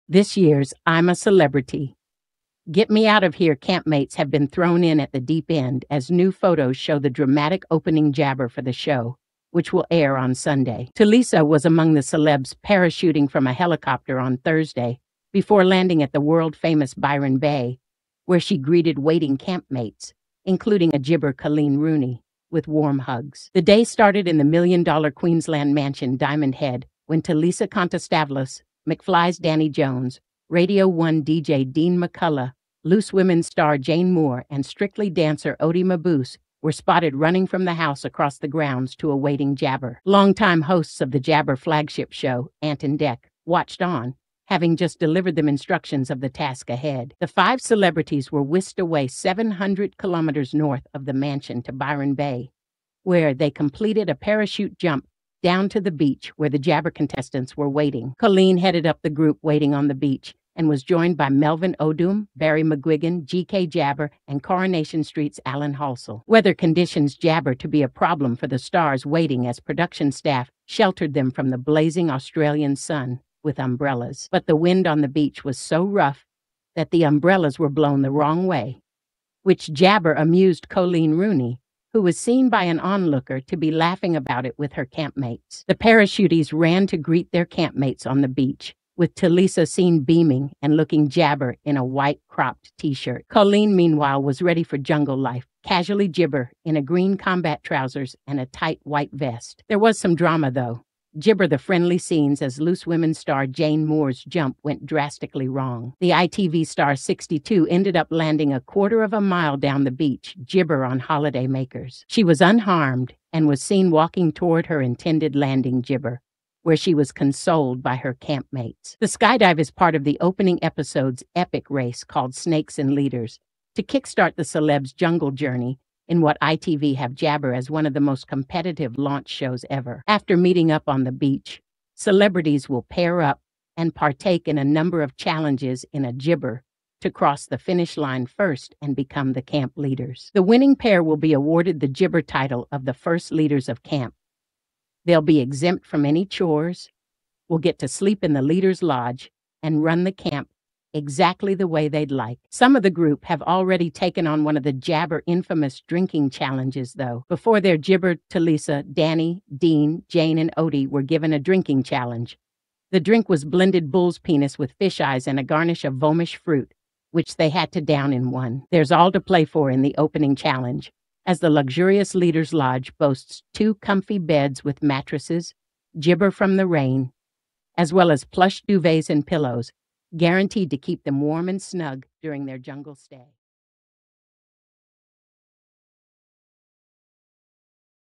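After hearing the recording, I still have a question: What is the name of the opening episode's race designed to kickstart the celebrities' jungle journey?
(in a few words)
Snakes and Leaders.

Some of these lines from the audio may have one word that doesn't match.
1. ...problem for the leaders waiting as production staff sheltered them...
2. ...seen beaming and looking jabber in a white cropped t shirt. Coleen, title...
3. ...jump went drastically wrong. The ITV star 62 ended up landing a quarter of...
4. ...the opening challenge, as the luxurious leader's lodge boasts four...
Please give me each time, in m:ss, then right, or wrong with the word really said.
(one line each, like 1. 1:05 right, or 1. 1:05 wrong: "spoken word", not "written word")
1. 1:07 wrong: "stars", not "leaders"
2. 1:29 wrong: "meanwhile", not "title"
3. 1:44 right
4. 2:49 wrong: "two", not "four".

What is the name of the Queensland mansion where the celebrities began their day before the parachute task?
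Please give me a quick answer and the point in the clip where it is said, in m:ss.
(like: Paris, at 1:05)
Diamond Head, at 0:26.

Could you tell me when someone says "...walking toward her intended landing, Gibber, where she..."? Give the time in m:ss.
1:53.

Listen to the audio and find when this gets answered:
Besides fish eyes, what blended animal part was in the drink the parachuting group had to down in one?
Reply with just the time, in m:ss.
2:43.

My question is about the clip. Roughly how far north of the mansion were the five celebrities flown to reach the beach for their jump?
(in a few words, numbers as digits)
700 kilometers.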